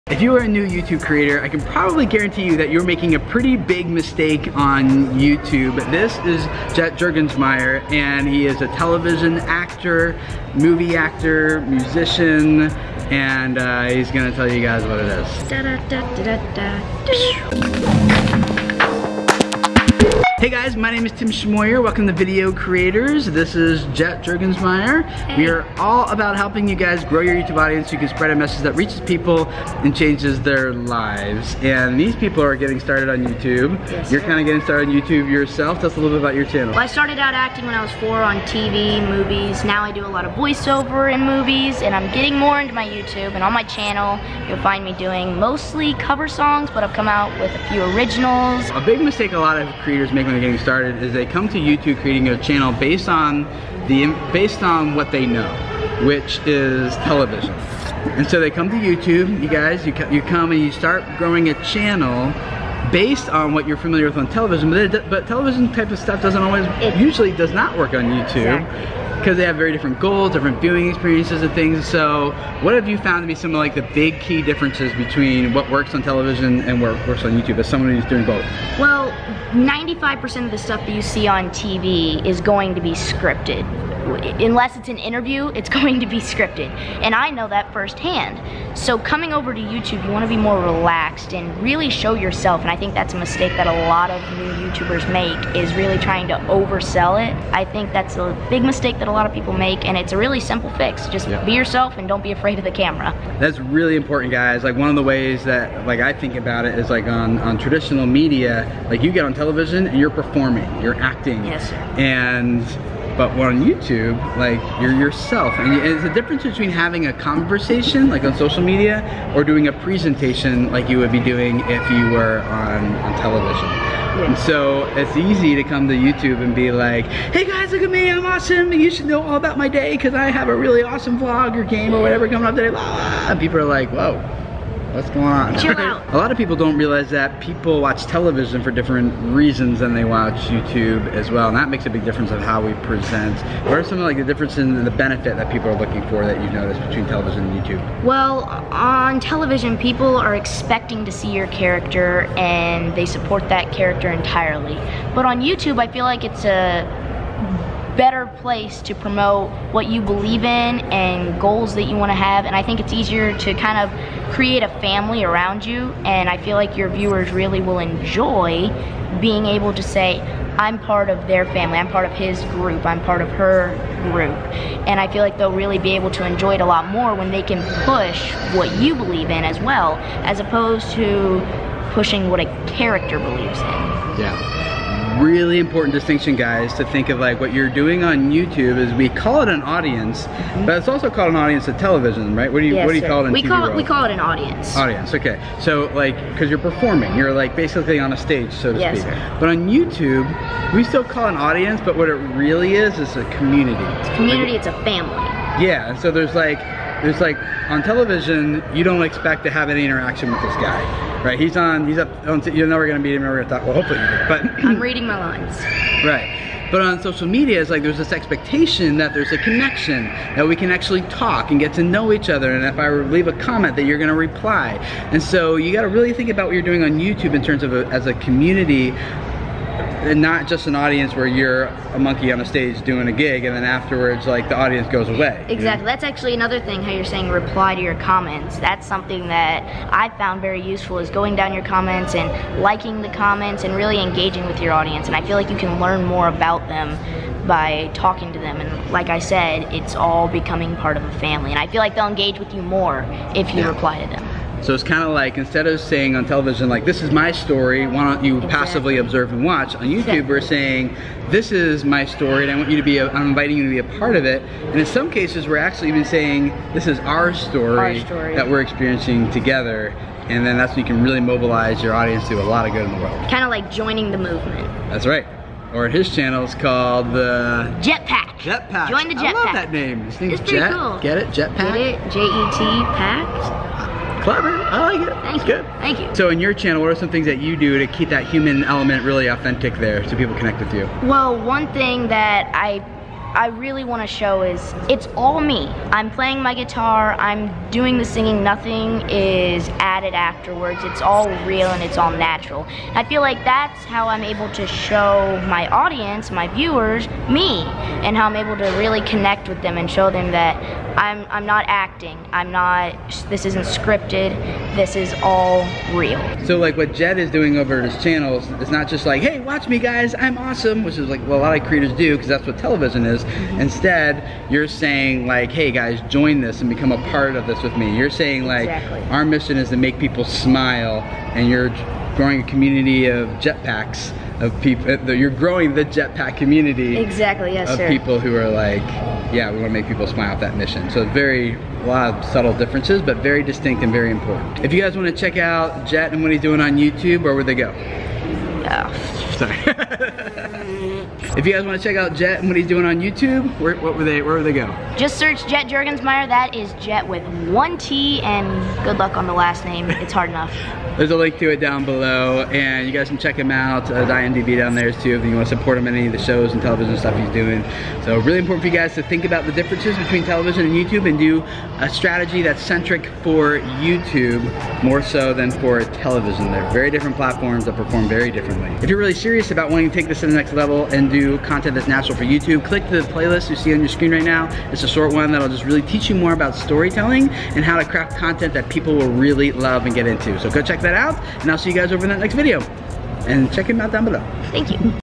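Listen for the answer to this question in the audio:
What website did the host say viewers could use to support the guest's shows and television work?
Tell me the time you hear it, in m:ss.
6:04.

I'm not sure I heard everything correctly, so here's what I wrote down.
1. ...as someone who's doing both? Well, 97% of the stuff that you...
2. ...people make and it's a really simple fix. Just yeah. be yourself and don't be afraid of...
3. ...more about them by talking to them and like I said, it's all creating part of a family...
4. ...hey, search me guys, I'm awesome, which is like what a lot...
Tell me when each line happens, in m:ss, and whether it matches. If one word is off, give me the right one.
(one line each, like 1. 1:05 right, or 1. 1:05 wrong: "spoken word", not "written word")
1. 1:17 wrong: "95", not "97"
2. 1:39 right
3. 4:06 wrong: "becoming", not "creating"
4. 5:19 wrong: "watch", not "search".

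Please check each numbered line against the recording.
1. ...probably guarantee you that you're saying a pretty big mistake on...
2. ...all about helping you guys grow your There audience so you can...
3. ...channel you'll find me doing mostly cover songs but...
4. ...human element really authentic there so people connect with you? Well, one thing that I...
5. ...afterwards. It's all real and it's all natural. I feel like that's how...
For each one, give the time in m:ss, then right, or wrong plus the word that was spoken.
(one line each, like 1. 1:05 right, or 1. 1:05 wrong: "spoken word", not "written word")
1. 0:01 wrong: "making", not "saying"
2. 0:25 wrong: "YouTube", not "There"
3. 0:43 right
4. 4:48 right
5. 5:00 right.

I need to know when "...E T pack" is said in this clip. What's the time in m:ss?
4:42.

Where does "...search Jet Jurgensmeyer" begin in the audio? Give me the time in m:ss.
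5:55.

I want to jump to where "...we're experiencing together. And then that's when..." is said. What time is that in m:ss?
4:28.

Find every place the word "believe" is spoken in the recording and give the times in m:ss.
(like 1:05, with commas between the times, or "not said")
2:40, 2:58, 3:03.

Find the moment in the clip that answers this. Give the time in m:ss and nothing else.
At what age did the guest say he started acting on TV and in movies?
0:37.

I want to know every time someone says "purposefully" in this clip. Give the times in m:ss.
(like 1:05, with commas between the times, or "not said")
not said.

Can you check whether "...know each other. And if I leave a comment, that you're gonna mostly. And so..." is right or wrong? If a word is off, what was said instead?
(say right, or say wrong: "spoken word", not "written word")
wrong: "reply", not "mostly".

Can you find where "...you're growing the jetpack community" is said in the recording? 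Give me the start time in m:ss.
5:35.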